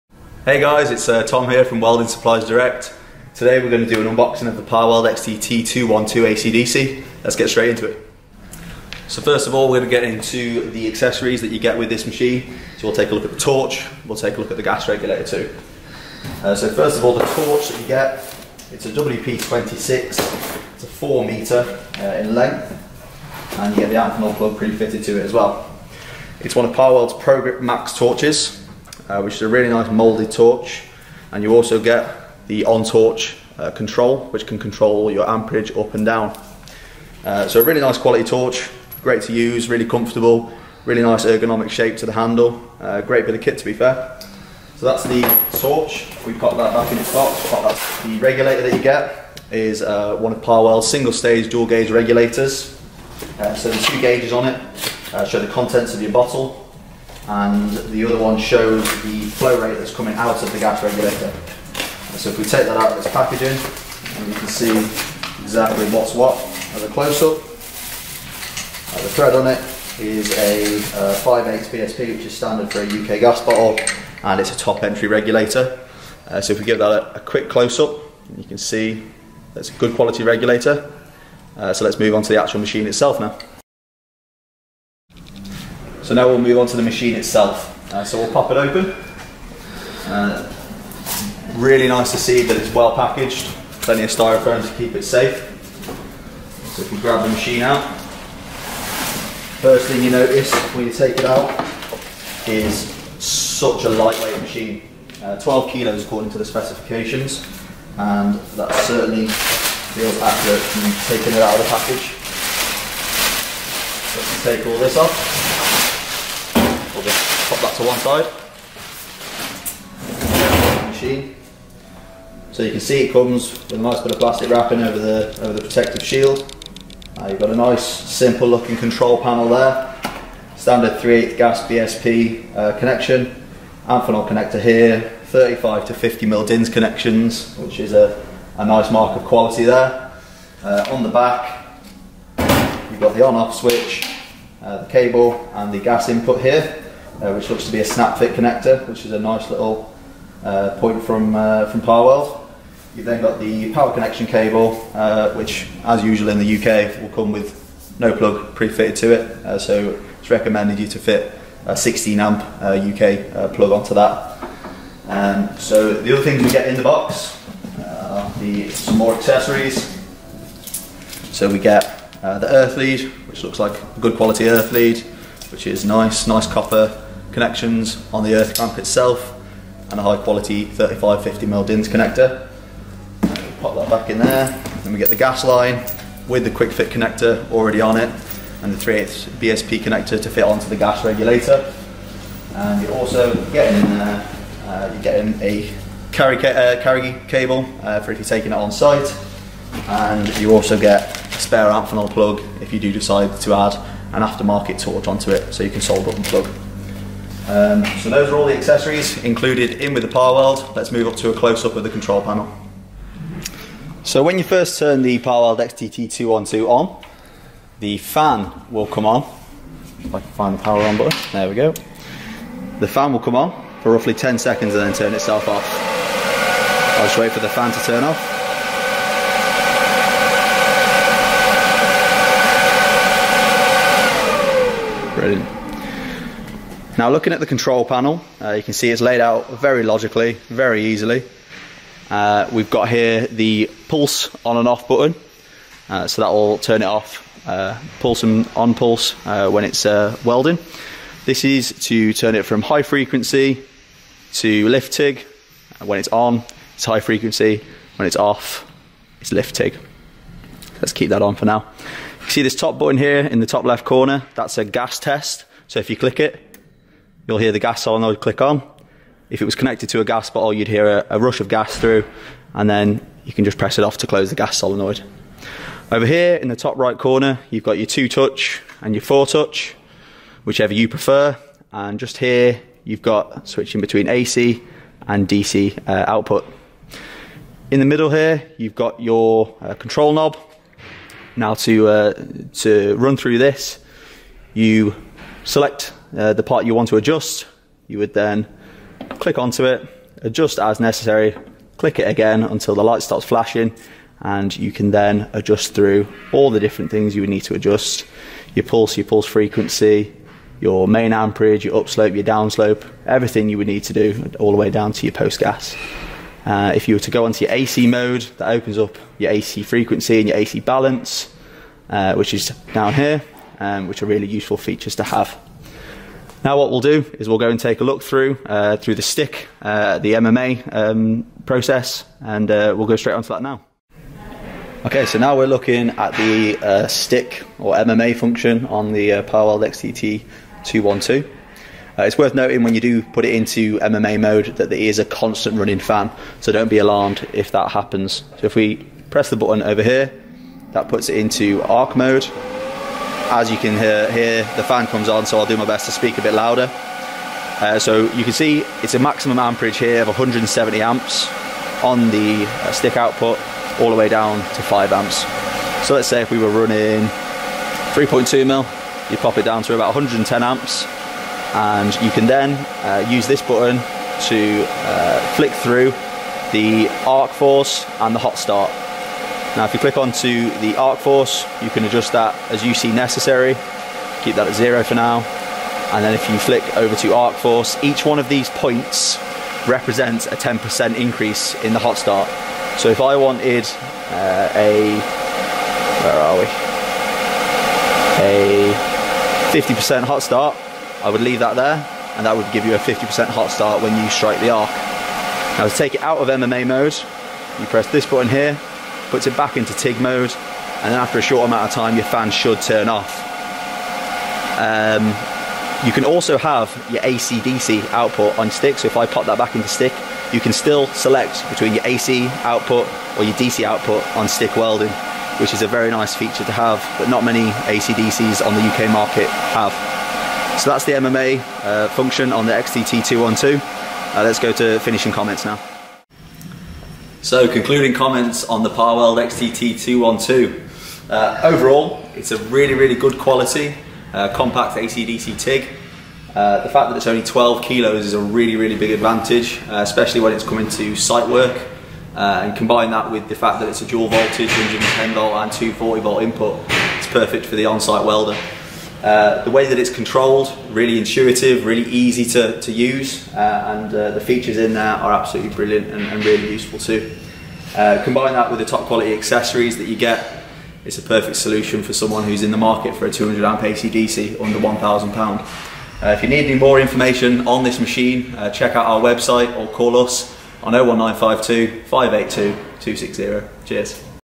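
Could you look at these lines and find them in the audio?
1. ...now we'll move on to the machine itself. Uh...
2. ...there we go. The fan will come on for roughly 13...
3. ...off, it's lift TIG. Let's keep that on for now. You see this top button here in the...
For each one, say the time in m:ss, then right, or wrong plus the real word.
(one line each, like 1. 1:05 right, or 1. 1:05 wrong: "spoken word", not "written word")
1. 1:26 right
2. 3:41 wrong: "10", not "13"
3. 4:18 right.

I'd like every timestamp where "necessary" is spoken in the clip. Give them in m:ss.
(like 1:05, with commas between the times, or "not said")
5:00, 6:22.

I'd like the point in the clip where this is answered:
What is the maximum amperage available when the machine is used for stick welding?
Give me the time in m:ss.
6:00.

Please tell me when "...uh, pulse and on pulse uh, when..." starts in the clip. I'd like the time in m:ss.
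4:07.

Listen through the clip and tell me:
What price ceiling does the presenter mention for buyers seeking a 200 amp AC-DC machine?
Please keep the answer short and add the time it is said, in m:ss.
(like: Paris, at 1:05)
£1,000, at 7:54.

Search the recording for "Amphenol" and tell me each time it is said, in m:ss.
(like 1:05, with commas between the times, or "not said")
0:23, 2:13, 3:21.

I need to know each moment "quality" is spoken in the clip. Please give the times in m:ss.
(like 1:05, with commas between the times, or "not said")
0:37, 1:19, 2:19, 2:54, 3:00, 7:23, 7:48.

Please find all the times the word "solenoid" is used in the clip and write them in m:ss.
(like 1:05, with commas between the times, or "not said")
4:27, 4:34.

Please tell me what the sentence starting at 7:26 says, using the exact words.
Uh, the fact that it's only 12 kilos is a really, really big advantage, uh, especially when it's coming to site work.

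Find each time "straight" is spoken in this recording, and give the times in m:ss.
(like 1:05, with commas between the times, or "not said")
0:07, 5:32.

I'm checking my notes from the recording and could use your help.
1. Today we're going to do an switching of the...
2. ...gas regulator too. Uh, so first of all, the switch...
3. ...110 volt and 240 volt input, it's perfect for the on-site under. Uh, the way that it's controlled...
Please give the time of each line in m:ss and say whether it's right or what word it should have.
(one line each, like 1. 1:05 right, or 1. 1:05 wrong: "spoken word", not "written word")
1. 0:03 wrong: "unboxing", not "switching"
2. 0:14 wrong: "torch", not "switch"
3. 7:34 wrong: "welder", not "under".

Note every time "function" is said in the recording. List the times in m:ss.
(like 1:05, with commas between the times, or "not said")
5:38, 7:11.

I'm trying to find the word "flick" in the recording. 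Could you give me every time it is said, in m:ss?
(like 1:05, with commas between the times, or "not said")
6:15, 6:26.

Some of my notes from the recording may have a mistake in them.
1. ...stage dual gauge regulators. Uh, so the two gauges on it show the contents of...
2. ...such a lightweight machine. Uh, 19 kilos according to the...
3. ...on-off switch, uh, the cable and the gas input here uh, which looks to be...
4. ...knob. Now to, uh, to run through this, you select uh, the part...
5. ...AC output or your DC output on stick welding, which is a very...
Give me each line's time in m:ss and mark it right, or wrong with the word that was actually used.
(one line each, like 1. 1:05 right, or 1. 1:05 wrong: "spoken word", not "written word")
1. 0:51 right
2. 1:43 wrong: "12", not "19"
3. 2:23 right
4. 4:50 right
5. 7:01 right.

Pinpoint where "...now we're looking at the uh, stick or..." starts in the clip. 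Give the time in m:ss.
5:35.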